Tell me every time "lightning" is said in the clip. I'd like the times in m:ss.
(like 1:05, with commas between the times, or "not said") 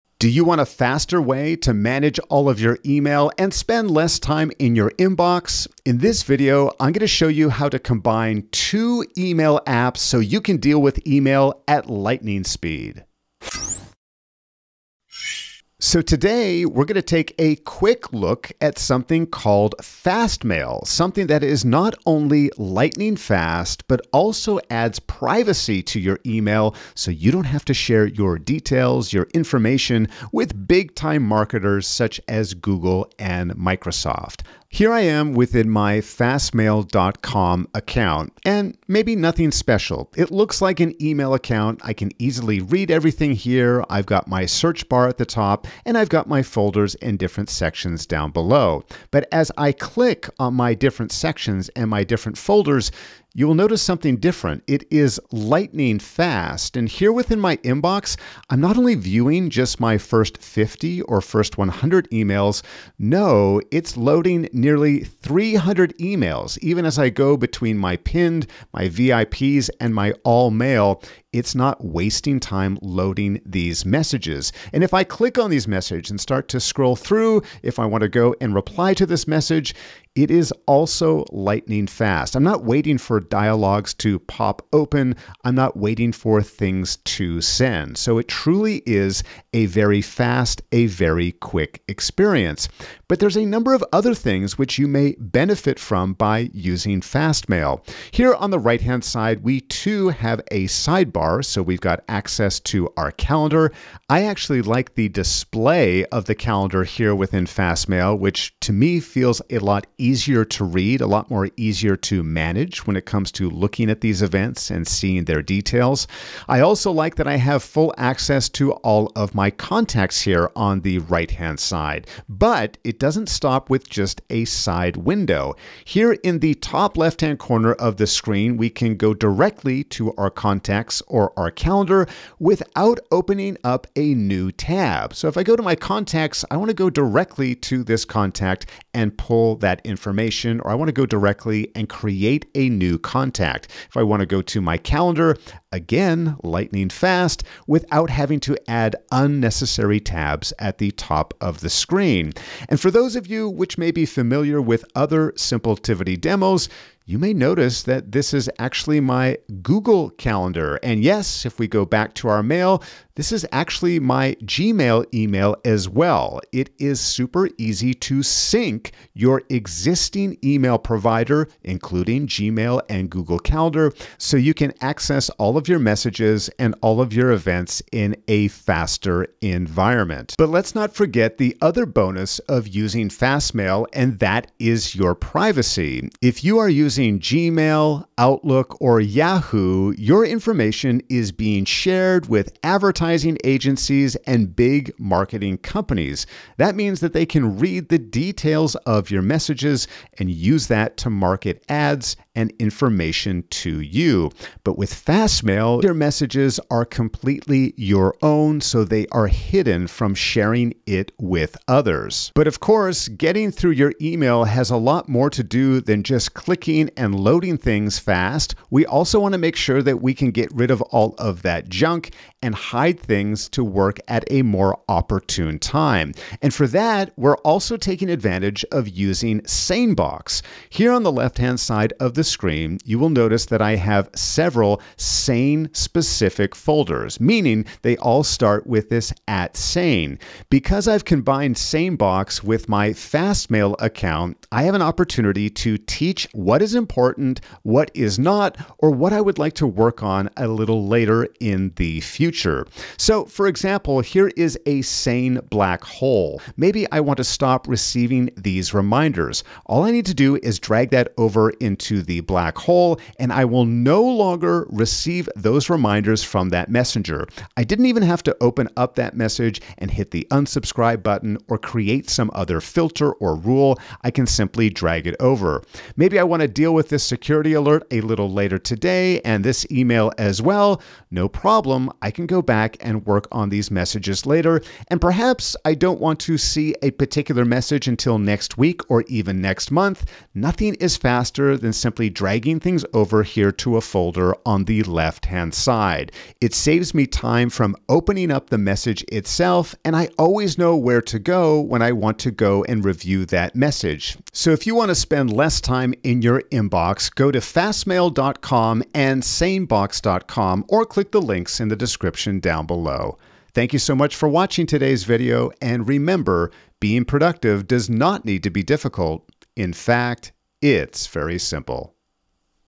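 0:11, 0:22, 0:55, 1:21, 2:26.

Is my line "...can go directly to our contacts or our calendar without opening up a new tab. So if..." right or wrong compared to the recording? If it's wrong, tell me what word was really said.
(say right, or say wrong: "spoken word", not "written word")
right.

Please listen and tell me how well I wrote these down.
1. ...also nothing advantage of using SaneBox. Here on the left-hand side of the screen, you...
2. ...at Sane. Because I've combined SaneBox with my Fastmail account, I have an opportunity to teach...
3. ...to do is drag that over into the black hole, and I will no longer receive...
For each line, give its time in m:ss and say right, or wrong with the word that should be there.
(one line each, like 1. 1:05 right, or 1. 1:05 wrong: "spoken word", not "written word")
1. 3:47 wrong: "taking", not "nothing"
2. 3:59 right
3. 4:20 right.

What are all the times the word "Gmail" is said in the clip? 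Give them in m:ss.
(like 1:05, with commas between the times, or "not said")
2:44, 2:52, 3:07.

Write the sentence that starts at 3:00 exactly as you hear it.
But let's not forget the other bonus of using Fastmail, and that is your privacy.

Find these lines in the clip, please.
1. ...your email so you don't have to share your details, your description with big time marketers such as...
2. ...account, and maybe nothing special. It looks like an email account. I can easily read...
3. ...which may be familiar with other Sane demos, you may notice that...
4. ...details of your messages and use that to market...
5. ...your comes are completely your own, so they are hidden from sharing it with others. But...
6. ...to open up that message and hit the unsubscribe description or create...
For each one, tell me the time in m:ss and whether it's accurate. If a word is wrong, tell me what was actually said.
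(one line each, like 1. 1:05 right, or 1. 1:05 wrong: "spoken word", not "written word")
1. 0:25 wrong: "information", not "description"
2. 0:37 right
3. 2:33 wrong: "Simpletivity", not "Sane"
4. 3:17 right
5. 3:25 wrong: "messages", not "comes"
6. 4:28 wrong: "button", not "description".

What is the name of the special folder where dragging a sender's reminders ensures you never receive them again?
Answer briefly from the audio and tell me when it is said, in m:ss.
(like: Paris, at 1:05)
sane black hole, at 4:14.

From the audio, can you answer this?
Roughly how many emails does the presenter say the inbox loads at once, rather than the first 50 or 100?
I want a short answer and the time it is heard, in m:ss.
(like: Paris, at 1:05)
300, at 1:05.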